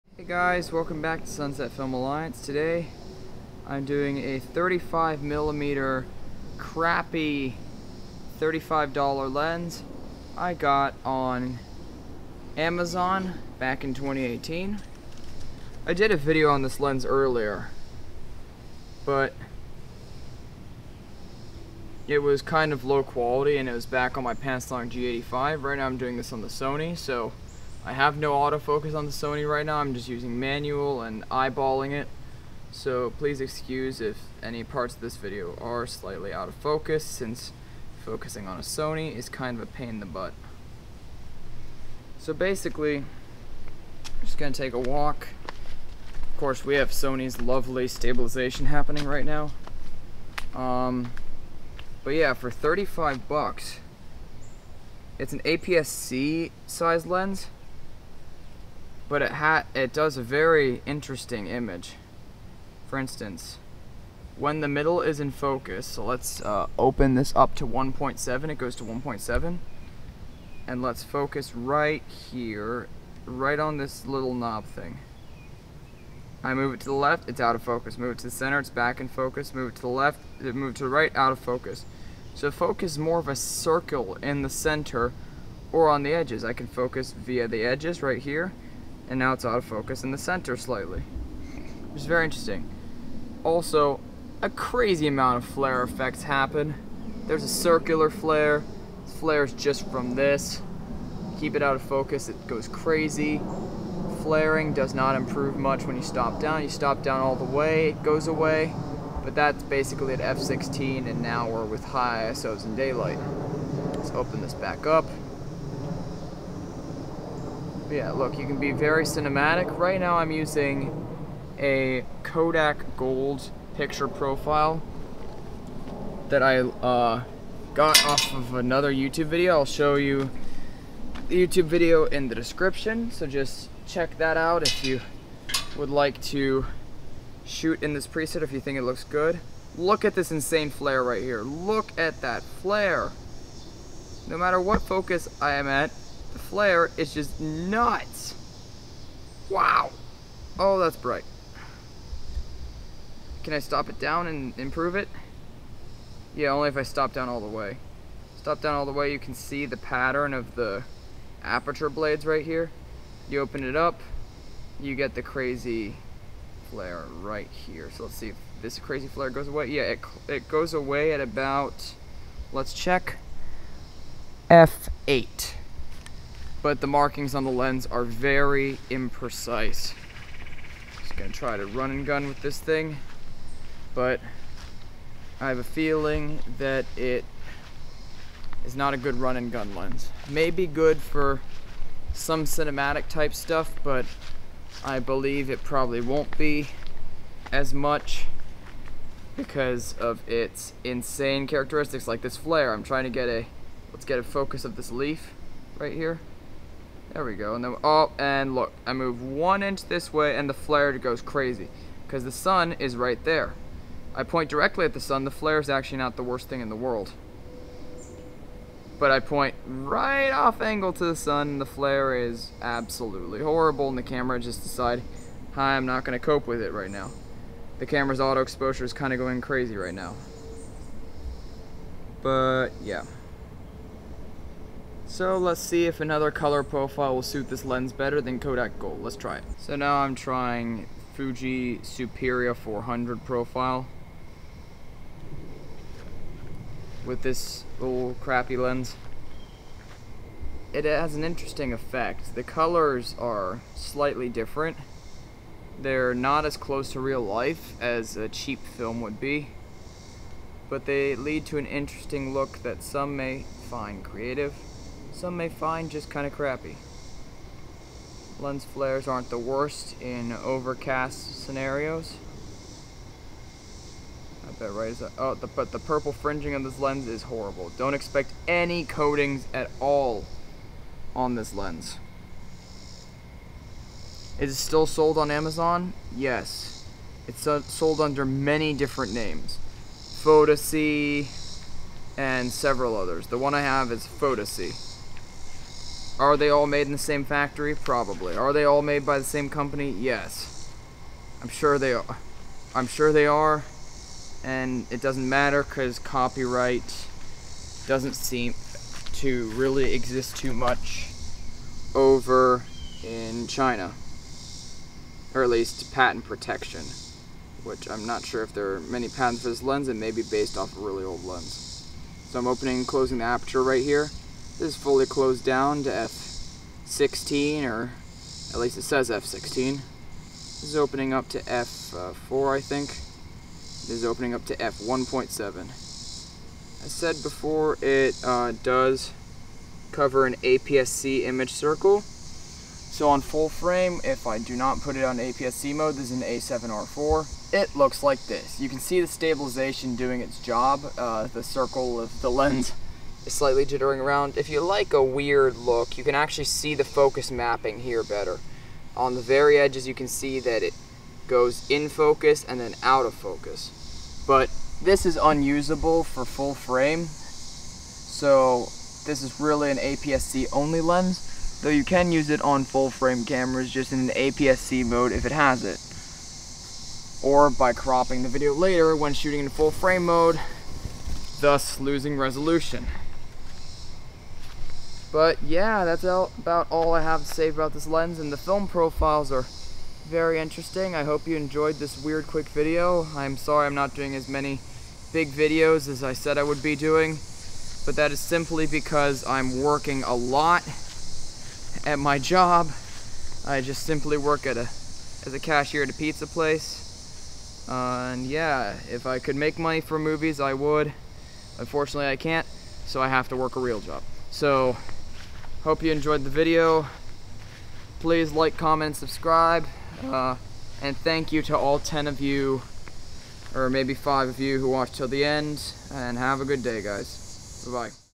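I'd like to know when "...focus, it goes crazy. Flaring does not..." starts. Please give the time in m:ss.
1:41.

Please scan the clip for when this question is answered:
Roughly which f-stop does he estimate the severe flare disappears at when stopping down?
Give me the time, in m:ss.
2:54.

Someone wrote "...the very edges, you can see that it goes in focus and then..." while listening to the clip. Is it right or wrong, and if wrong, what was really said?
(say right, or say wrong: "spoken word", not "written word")
right.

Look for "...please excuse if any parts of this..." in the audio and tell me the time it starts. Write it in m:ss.
0:33.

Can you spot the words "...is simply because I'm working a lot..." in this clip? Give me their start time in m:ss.
6:38.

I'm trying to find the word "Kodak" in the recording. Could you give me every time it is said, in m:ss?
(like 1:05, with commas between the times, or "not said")
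2:02, 3:58.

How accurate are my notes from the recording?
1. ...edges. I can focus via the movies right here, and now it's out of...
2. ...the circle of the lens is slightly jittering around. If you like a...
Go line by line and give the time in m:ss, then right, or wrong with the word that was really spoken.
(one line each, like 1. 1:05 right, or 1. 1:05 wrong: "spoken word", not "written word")
1. 1:26 wrong: "edges", not "movies"
2. 5:51 right.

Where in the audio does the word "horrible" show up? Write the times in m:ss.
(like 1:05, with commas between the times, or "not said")
3:43, 4:37.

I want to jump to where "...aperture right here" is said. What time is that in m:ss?
5:23.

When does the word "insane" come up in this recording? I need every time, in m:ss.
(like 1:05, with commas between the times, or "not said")
2:20, 3:20.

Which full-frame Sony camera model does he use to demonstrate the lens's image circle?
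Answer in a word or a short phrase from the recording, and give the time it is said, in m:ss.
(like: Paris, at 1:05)
A7R4, at 5:46.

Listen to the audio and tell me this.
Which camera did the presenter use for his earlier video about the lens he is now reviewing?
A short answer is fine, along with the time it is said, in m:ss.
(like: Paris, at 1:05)
Panasonic G85, at 0:24.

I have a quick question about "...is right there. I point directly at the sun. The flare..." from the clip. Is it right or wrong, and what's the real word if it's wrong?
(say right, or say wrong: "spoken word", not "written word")
right.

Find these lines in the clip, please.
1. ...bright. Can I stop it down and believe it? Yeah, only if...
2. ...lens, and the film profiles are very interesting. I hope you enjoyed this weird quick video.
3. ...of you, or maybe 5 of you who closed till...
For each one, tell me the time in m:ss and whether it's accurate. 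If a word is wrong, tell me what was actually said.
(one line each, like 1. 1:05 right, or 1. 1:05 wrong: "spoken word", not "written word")
1. 2:30 wrong: "improve", not "believe"
2. 6:27 right
3. 7:02 wrong: "watched", not "closed".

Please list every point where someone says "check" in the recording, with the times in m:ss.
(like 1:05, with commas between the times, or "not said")
2:13, 2:52.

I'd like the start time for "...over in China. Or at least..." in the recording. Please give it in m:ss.
5:11.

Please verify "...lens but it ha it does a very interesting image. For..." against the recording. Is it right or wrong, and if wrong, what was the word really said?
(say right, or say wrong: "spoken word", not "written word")
right.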